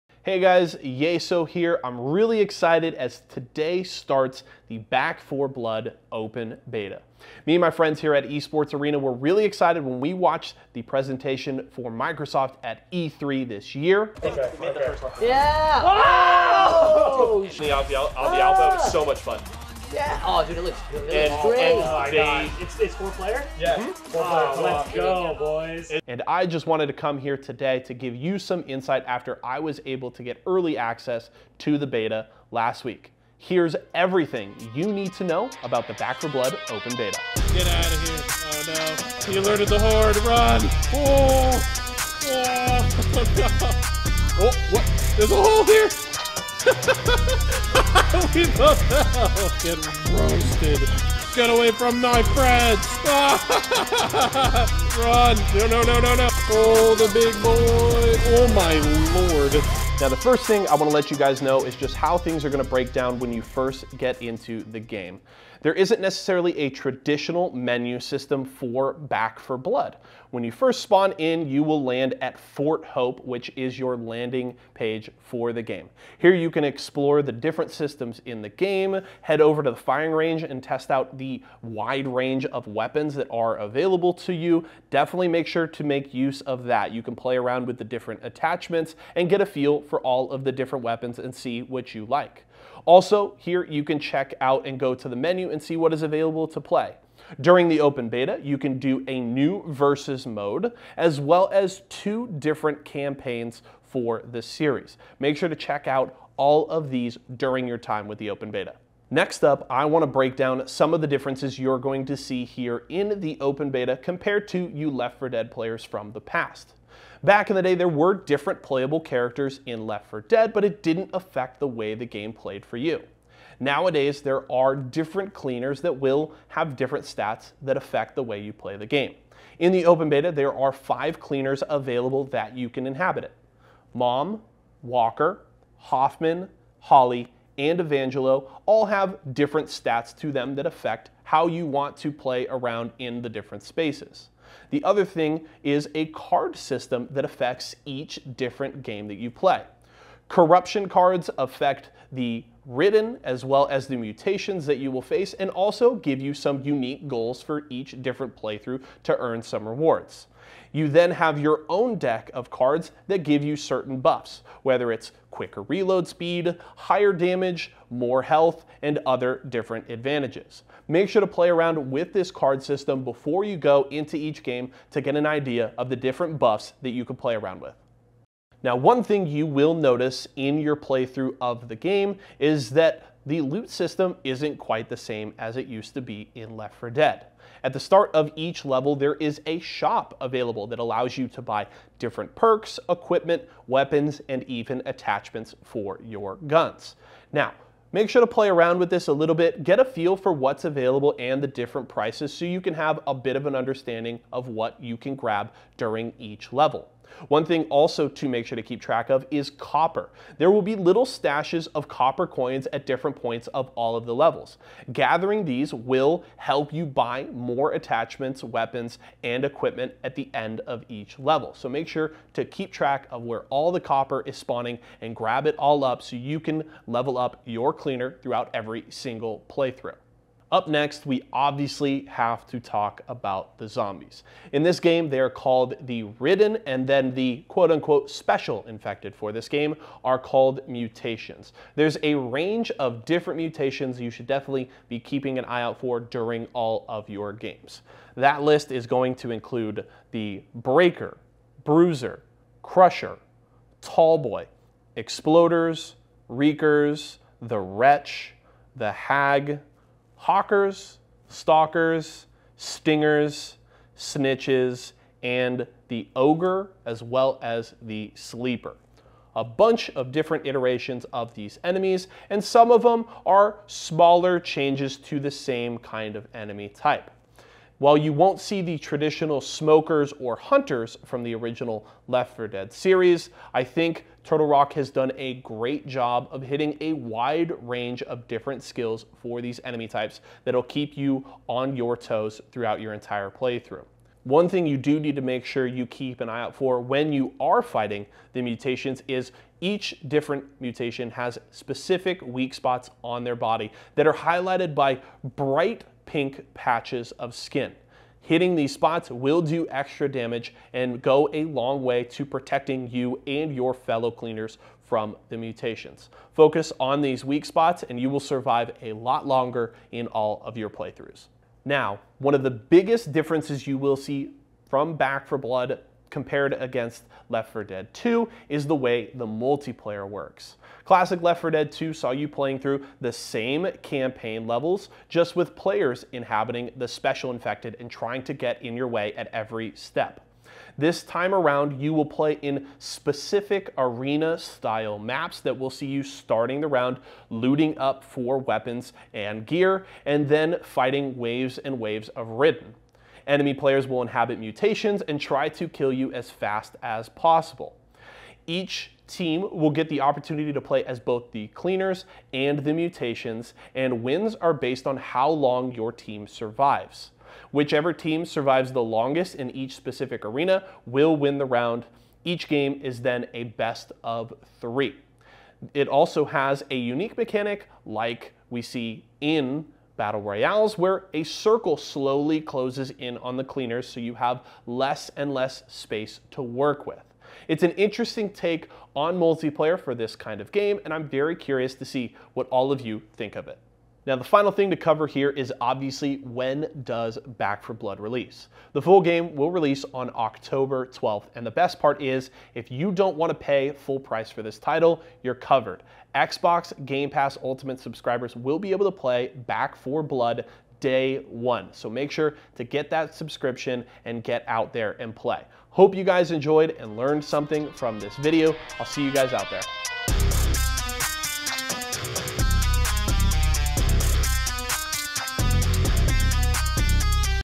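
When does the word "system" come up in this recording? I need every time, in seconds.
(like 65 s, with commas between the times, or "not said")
67 s, 77 s, 146 s, 172 s, 183 s.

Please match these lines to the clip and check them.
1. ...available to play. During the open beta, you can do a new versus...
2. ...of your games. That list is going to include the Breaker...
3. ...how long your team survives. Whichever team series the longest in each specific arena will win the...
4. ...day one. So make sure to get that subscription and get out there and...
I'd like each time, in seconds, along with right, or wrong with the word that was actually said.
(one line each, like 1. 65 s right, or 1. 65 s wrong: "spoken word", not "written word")
1. 96 s right
2. 246 s right
3. 364 s wrong: "survives", not "series"
4. 410 s right.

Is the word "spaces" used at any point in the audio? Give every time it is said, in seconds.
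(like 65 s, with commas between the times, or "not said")
143 s, 385 s.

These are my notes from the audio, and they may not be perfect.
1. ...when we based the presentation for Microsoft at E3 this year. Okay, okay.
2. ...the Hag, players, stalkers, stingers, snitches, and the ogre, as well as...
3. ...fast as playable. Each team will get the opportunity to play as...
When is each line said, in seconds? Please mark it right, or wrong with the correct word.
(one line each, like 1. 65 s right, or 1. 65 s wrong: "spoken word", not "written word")
1. 9 s wrong: "watched", not "based"
2. 258 s wrong: "hockers", not "players"
3. 356 s wrong: "possible", not "playable".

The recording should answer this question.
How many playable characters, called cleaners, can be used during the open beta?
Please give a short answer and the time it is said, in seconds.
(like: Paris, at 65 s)
5, at 130 s.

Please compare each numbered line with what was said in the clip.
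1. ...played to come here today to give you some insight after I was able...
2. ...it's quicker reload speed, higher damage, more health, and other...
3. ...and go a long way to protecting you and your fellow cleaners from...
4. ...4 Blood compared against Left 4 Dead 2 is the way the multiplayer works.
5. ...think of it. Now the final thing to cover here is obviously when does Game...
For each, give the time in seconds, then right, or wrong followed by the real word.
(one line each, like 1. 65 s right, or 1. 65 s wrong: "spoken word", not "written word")
1. 26 s wrong: "wanted", not "played"
2. 164 s right
3. 310 s right
4. 325 s right
5. 393 s wrong: "Back", not "Game".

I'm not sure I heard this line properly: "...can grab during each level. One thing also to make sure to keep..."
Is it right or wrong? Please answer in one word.
right.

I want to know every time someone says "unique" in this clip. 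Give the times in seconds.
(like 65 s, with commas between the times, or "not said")
156 s, 376 s.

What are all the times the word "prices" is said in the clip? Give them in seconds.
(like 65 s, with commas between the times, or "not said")
201 s, 404 s.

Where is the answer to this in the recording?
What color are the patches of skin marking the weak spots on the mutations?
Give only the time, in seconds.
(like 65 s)
305 s.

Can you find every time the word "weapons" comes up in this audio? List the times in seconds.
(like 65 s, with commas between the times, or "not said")
82 s, 90 s, 193 s, 218 s, 348 s.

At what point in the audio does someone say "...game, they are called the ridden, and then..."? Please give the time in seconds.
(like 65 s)
234 s.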